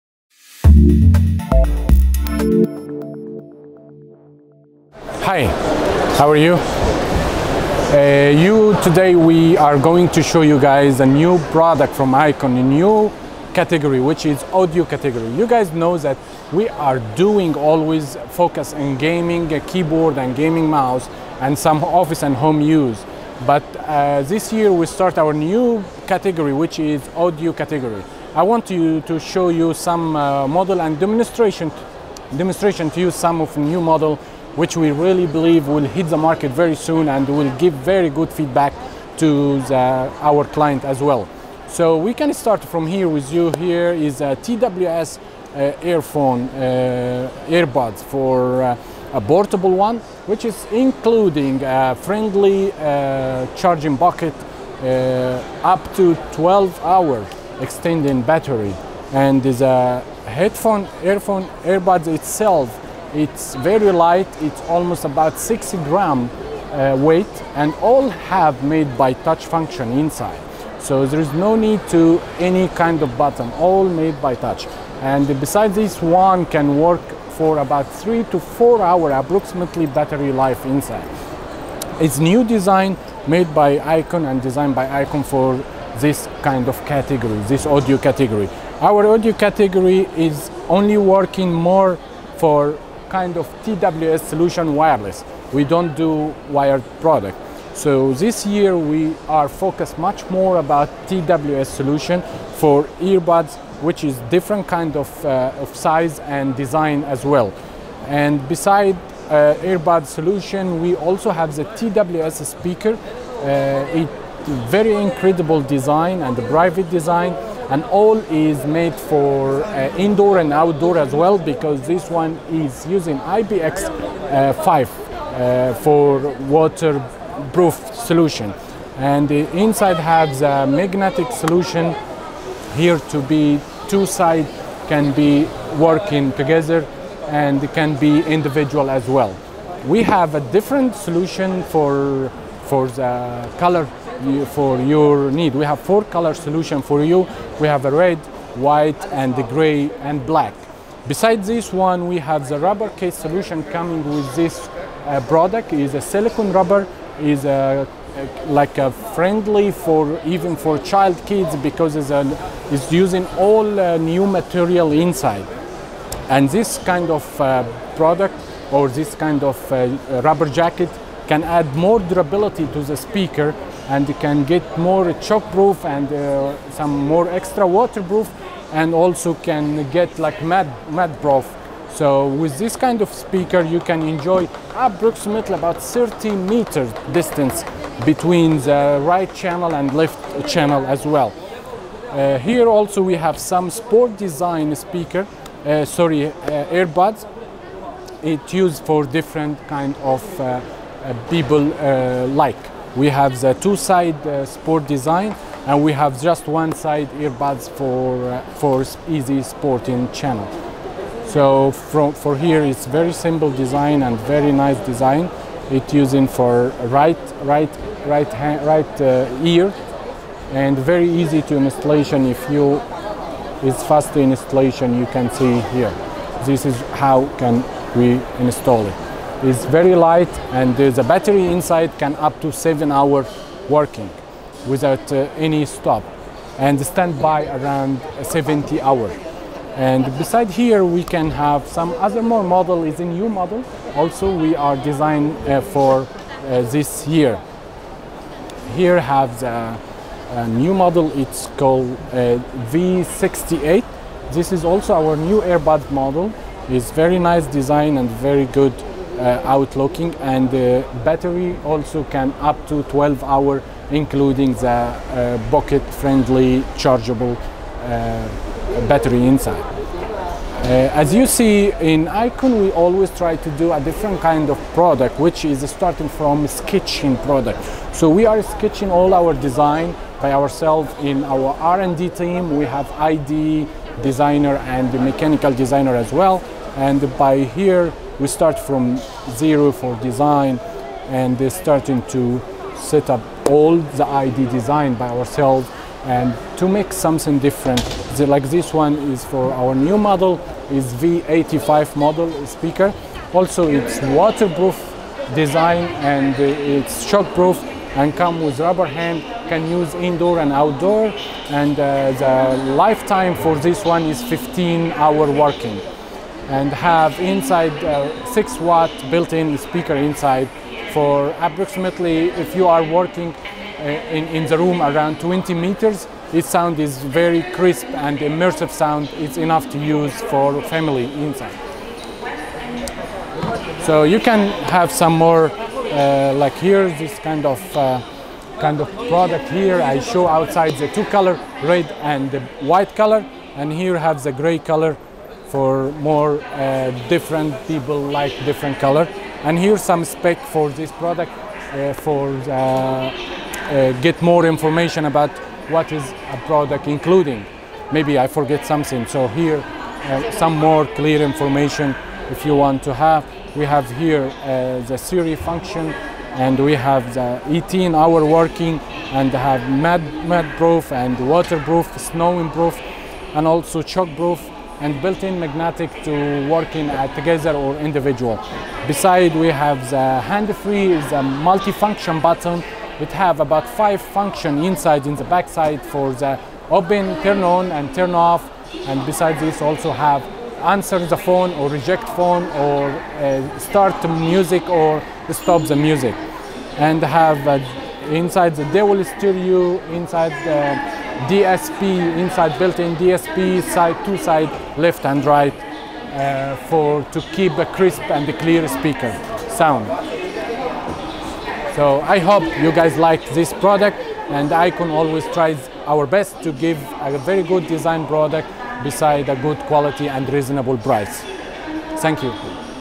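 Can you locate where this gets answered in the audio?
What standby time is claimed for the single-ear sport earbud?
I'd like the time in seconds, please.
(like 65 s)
238 s.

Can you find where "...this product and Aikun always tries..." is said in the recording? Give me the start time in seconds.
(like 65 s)
413 s.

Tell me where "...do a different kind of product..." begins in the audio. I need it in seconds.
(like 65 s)
273 s.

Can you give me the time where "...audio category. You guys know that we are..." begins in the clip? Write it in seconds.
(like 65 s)
14 s.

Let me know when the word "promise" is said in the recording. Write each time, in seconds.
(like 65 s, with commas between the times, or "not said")
not said.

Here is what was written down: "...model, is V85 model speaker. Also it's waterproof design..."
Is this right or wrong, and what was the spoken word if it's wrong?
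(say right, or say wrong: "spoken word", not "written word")
right.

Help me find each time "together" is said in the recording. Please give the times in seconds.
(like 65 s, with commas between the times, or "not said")
136 s, 377 s.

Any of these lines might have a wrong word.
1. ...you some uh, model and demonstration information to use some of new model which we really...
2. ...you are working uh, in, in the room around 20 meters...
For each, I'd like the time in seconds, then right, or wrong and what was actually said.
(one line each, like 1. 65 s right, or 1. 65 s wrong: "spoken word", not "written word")
1. 29 s wrong: "demonstration", not "information"
2. 322 s right.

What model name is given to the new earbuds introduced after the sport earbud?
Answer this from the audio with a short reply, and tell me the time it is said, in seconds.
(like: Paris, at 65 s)
V68, at 252 s.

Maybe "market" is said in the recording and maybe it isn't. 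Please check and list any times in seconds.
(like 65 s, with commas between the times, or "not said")
36 s.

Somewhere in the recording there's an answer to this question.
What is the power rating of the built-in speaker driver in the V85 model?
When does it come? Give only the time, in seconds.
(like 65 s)
318 s.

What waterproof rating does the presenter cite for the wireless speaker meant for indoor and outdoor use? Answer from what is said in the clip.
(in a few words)
IPX5.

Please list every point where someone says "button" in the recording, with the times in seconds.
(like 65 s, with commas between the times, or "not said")
73 s, 382 s.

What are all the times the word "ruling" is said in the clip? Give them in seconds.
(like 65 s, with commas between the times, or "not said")
not said.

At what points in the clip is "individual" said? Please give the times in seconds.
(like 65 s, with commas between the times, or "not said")
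138 s, 377 s.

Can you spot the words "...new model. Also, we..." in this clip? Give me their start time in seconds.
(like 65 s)
243 s.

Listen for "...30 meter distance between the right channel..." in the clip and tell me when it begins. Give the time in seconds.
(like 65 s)
185 s.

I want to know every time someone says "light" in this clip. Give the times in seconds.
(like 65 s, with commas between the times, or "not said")
63 s, 229 s.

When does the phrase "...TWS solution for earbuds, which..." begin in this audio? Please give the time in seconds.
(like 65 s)
101 s.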